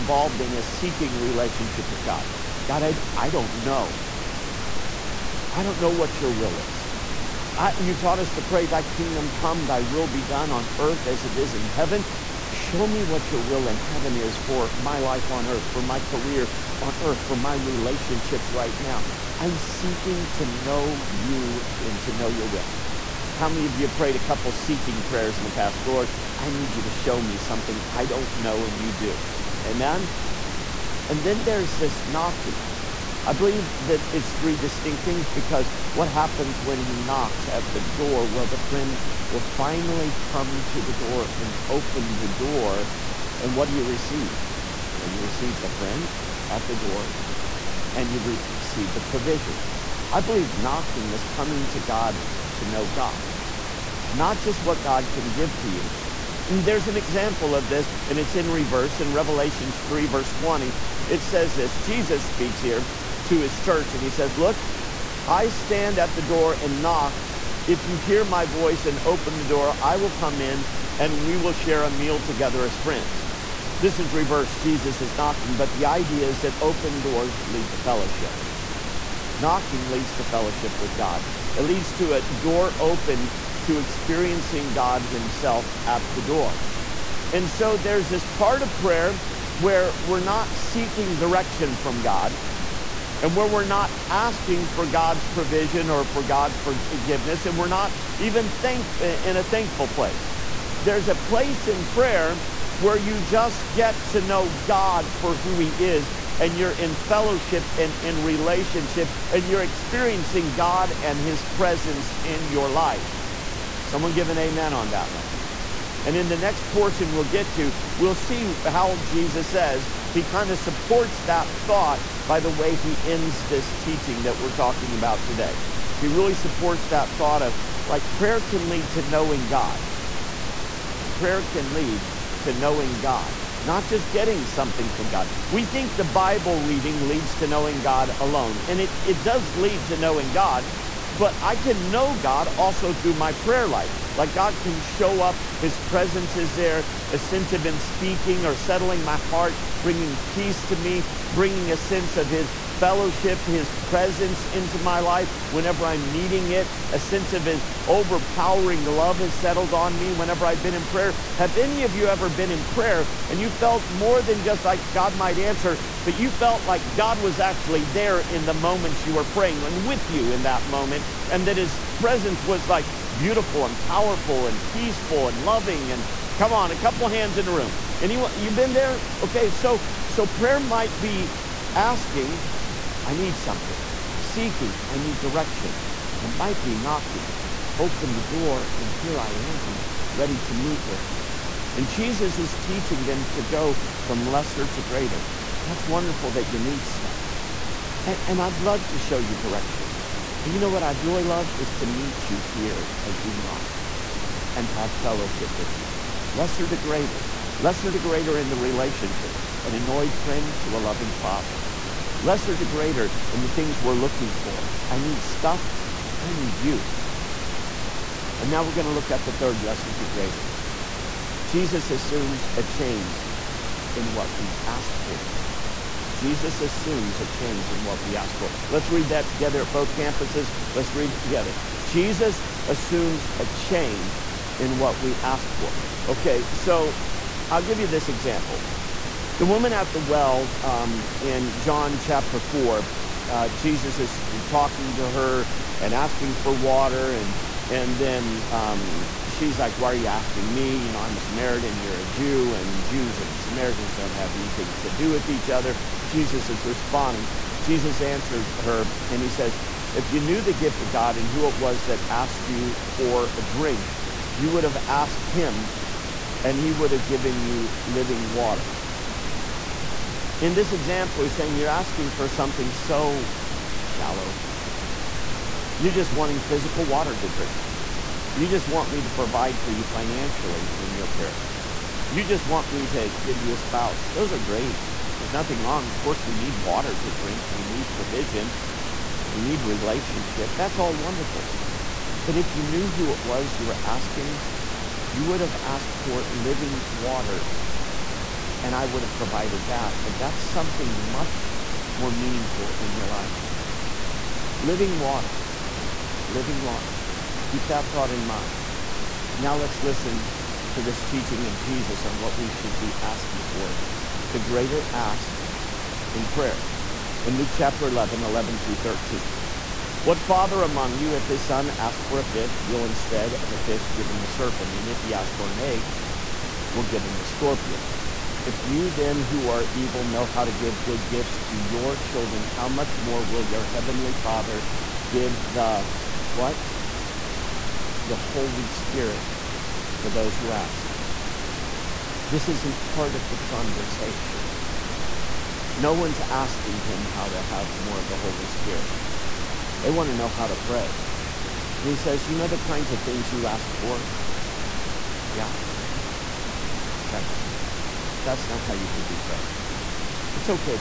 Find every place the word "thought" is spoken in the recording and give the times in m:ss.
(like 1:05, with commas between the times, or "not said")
2:01, 2:07, 5:07.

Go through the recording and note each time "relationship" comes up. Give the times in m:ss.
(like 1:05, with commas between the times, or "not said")
0:01, 0:17, 1:48, 3:28, 4:49.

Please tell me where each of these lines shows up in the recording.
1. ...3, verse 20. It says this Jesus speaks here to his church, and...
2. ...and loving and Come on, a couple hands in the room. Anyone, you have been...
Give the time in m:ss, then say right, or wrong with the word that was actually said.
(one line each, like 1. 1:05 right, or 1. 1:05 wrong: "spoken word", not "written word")
1. 0:59 right
2. 2:55 right.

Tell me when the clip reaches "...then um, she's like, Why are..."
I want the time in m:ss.
4:07.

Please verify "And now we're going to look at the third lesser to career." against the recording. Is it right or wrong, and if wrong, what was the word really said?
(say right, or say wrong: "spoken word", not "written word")
wrong: "greater", not "career".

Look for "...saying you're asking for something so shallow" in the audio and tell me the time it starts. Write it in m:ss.
4:31.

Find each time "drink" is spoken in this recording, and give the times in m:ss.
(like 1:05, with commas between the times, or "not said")
4:23, 4:37, 4:47.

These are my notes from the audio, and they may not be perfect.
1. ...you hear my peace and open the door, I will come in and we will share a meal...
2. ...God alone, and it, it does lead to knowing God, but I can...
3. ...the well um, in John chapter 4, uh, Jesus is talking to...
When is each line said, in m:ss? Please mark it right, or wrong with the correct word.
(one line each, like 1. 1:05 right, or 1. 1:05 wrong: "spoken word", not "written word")
1. 1:07 wrong: "voice", not "peace"
2. 2:17 right
3. 3:59 right.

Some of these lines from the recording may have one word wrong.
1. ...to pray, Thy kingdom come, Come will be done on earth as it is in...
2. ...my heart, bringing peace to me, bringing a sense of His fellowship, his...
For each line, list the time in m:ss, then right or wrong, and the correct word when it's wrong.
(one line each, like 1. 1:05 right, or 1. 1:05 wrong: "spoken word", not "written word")
1. 0:08 wrong: "Thy", not "Come"
2. 2:29 right.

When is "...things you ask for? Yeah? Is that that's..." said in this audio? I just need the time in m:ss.
5:53.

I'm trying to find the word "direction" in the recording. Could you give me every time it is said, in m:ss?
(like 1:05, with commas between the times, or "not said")
1:31, 3:05, 3:19.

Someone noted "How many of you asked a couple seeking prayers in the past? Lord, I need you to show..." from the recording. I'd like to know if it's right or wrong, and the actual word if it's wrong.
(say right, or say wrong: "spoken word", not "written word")
wrong: "prayed", not "asked".